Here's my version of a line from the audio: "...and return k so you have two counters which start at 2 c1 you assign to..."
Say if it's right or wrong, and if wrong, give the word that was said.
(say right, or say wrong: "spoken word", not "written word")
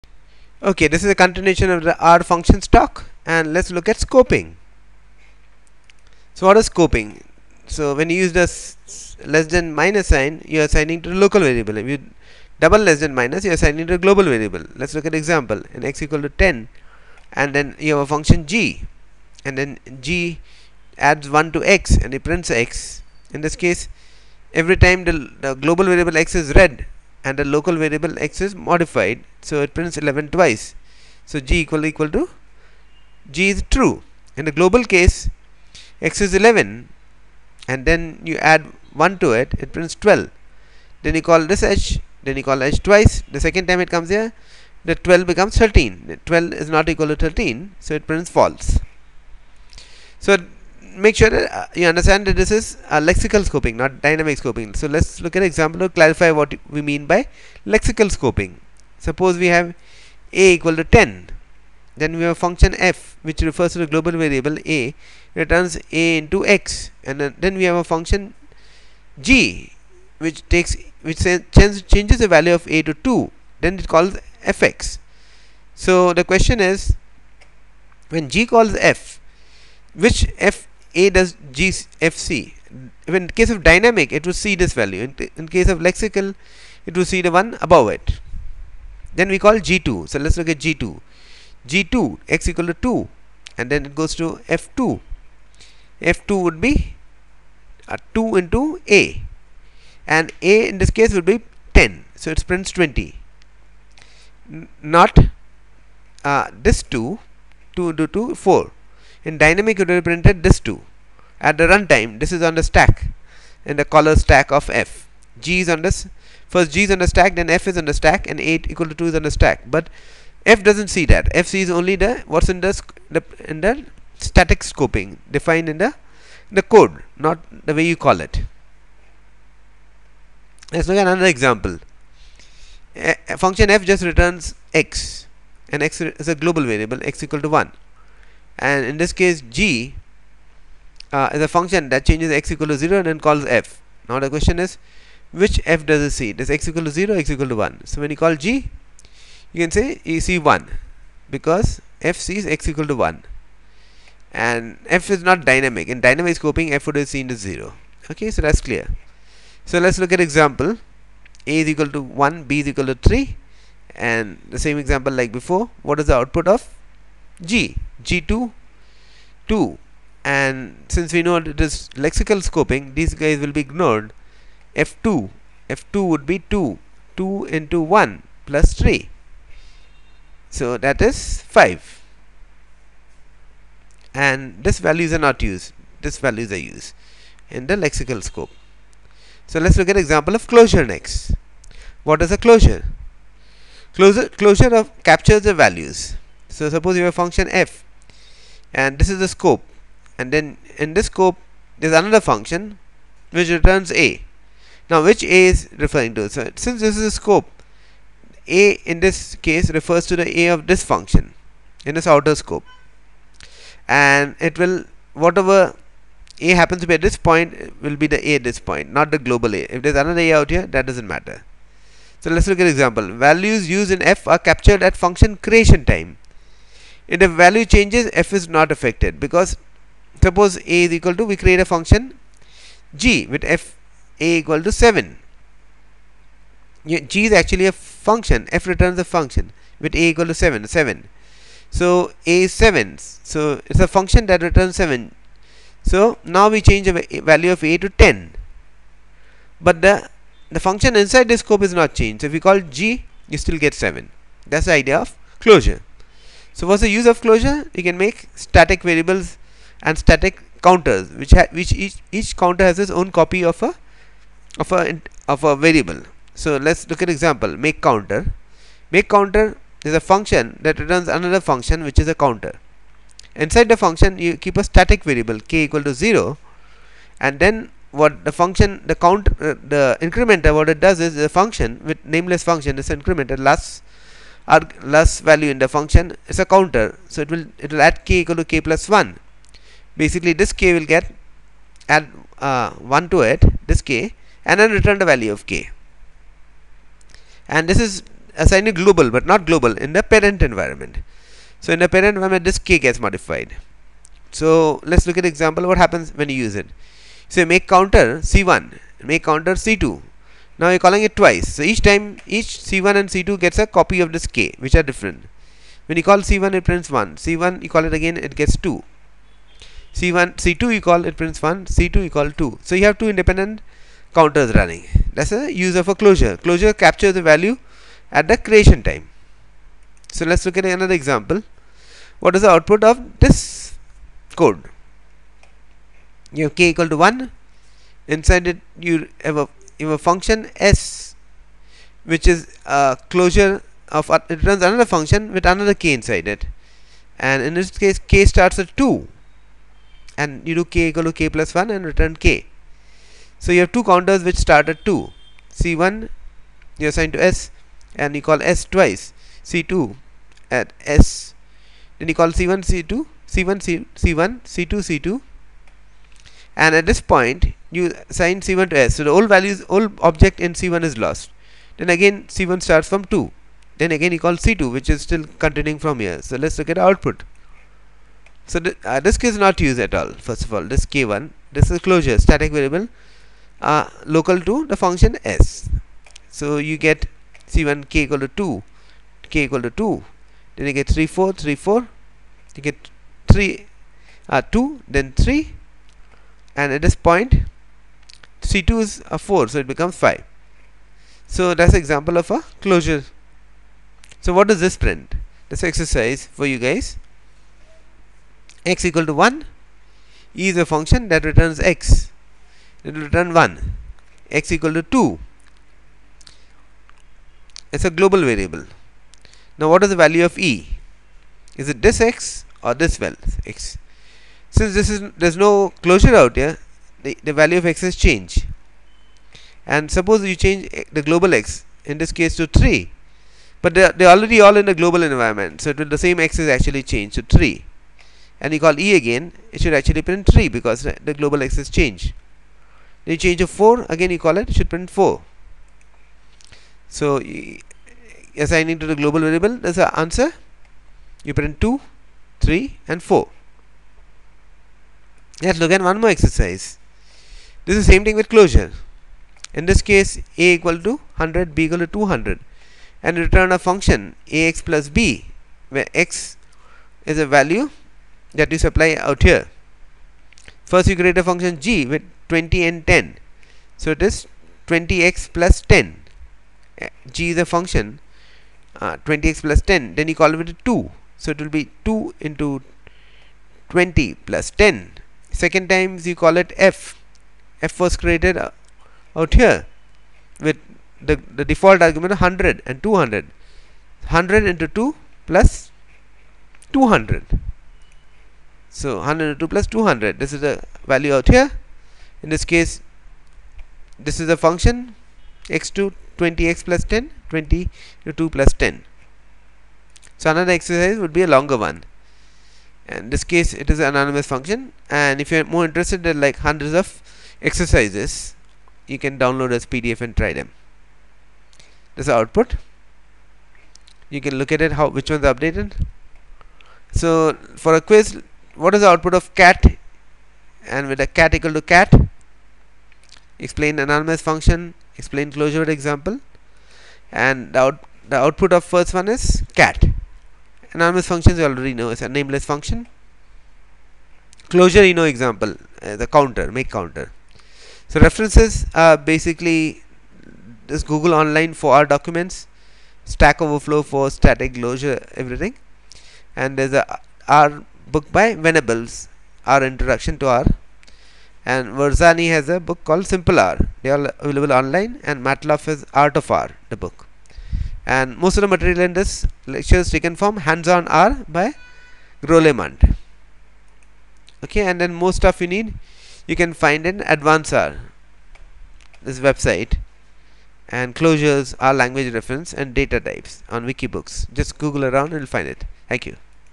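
right.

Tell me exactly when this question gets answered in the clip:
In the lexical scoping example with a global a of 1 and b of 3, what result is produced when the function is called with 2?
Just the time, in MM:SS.
03:00.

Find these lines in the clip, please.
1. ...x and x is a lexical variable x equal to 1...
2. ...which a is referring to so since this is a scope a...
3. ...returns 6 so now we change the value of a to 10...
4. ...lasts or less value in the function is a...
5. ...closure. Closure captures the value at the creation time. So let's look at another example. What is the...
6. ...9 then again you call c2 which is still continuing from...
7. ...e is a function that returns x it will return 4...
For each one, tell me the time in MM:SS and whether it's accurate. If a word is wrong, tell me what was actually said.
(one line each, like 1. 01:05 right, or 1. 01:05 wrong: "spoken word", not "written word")
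1. 02:14 wrong: "global", not "lexical"
2. 03:25 right
3. 04:04 wrong: "7", not "6"
4. 04:43 right
5. 05:25 right
6. 06:13 wrong: "2", not "9"
7. 06:50 wrong: "1", not "4".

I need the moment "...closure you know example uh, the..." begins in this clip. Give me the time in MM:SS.
09:04.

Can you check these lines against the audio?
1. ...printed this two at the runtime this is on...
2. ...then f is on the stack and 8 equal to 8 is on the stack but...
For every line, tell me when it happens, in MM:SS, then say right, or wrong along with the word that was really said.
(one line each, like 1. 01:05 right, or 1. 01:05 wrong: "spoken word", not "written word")
1. 01:50 right
2. 01:57 wrong: "2", not "8".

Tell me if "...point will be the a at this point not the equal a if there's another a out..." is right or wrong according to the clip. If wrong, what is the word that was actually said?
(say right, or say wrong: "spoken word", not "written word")
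wrong: "global", not "equal".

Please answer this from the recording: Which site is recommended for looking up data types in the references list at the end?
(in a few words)
Wikibooks.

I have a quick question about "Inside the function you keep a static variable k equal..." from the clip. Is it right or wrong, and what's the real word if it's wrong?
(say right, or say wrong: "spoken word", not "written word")
right.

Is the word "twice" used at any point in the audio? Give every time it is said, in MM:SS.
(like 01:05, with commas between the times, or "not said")
00:30, 00:42, 05:11, 05:58.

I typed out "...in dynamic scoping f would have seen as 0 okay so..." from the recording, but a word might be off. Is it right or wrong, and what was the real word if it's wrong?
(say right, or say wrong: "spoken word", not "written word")
right.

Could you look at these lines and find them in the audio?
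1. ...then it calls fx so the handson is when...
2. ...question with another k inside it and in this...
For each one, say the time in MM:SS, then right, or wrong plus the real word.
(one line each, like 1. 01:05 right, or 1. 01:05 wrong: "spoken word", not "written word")
1. 01:13 wrong: "question", not "handson"
2. 05:44 wrong: "function", not "question".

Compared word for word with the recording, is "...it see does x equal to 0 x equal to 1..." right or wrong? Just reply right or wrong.
right.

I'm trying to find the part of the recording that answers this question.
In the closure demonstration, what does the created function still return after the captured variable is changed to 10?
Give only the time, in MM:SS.
04:13.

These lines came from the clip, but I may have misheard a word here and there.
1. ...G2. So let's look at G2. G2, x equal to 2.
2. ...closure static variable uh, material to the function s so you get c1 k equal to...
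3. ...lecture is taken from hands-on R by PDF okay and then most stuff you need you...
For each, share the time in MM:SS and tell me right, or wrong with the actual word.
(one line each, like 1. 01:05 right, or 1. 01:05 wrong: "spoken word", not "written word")
1. 01:29 right
2. 06:21 wrong: "local", not "material"
3. 09:29 wrong: "Grolemund", not "PDF".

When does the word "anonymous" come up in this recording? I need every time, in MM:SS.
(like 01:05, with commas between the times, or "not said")
08:33, 08:53, 09:00.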